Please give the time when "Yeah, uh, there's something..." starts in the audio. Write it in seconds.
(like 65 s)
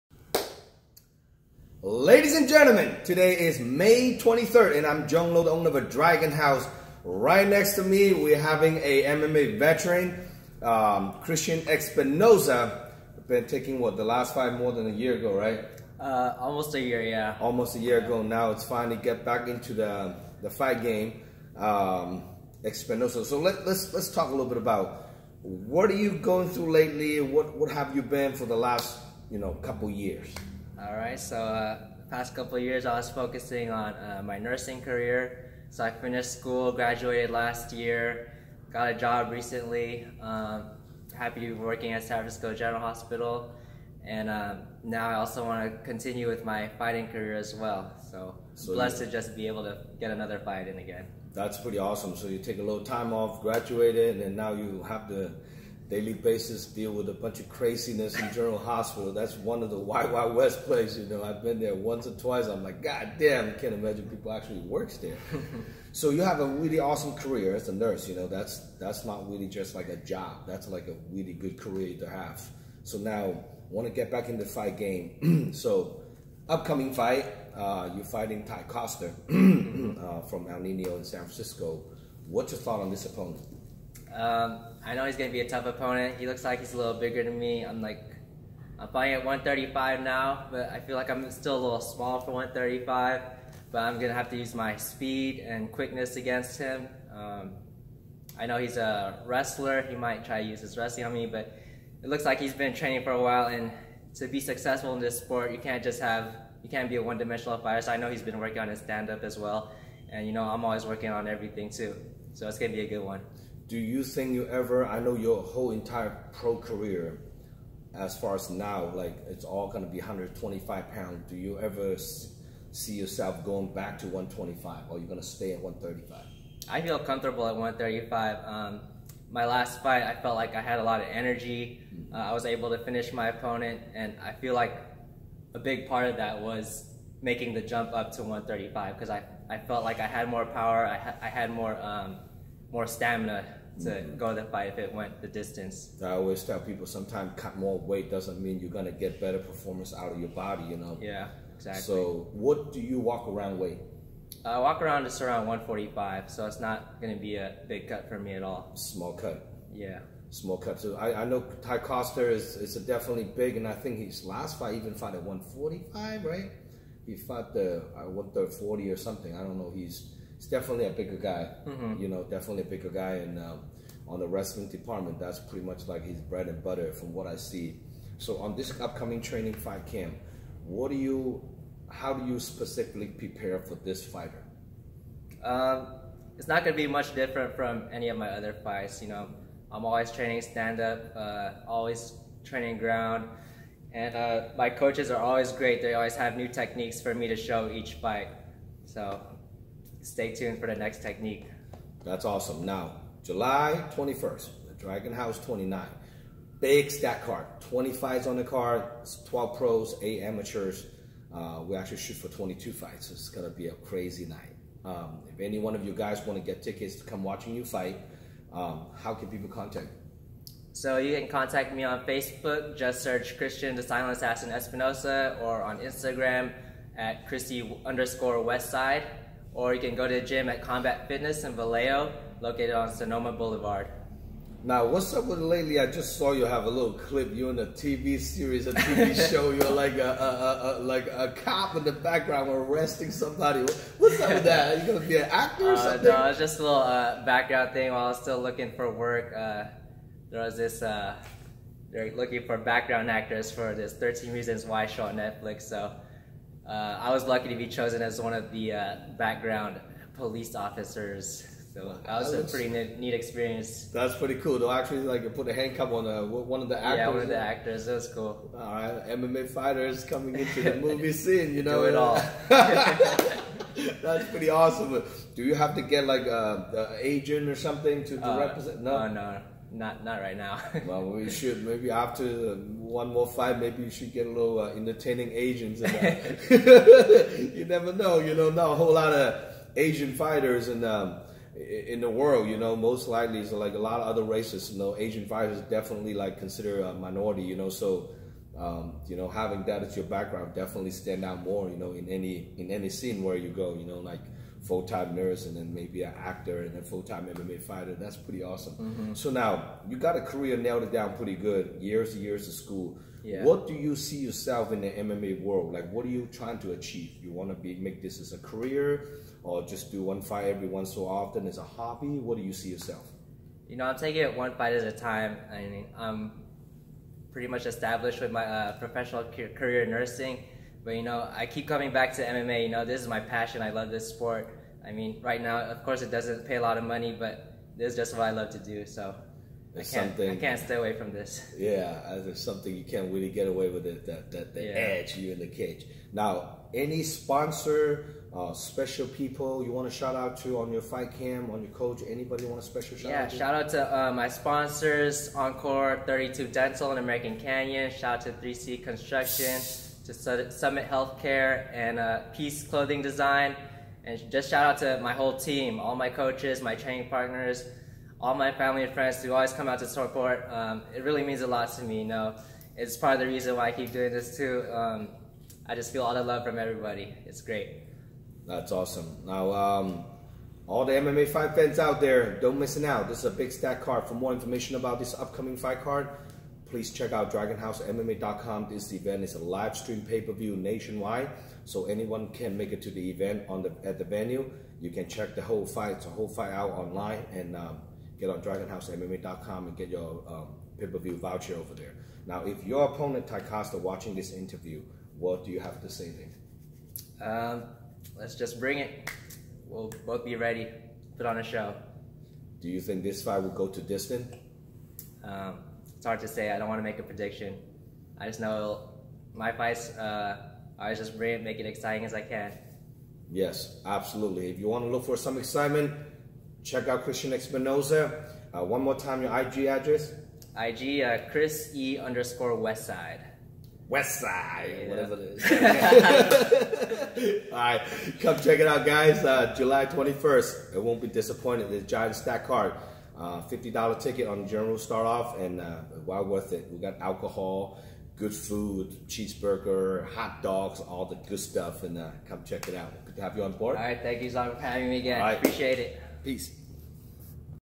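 341 s.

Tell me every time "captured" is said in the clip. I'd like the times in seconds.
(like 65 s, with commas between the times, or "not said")
not said.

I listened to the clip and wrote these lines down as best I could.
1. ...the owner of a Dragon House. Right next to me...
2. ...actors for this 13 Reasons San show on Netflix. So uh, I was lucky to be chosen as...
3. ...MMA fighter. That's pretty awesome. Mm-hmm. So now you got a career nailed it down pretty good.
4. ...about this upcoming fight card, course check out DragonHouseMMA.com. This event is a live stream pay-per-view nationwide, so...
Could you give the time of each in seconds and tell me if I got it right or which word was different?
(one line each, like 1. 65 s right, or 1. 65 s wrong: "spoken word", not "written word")
1. 5 s right
2. 253 s wrong: "Why", not "San"
3. 307 s right
4. 384 s wrong: "please", not "course".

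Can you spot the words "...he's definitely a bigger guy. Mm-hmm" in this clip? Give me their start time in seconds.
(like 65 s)
170 s.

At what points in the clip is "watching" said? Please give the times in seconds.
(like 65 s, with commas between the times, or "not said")
217 s, 403 s.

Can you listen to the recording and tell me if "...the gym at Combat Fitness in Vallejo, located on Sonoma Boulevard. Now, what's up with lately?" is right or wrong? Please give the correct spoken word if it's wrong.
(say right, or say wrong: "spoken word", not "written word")
right.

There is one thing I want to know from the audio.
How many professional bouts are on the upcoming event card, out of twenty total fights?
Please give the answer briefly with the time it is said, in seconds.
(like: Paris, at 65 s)
12, at 209 s.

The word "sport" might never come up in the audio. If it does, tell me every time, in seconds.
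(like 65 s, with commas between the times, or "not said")
105 s, 334 s.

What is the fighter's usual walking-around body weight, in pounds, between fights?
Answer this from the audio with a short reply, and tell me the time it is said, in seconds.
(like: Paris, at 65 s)
145, at 155 s.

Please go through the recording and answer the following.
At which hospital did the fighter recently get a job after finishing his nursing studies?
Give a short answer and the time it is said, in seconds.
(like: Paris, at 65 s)
San Francisco General Hospital, at 42 s.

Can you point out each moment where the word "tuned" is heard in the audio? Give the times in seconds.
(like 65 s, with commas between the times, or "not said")
200 s.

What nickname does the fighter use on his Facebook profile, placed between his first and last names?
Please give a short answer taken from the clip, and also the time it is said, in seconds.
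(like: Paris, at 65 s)
the Silent Assassin, at 223 s.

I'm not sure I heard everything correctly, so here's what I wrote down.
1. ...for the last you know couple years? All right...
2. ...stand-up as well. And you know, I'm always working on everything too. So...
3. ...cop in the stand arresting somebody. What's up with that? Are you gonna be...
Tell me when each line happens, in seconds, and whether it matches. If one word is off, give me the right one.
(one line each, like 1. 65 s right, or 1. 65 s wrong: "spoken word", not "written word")
1. 28 s right
2. 108 s right
3. 241 s wrong: "background", not "stand".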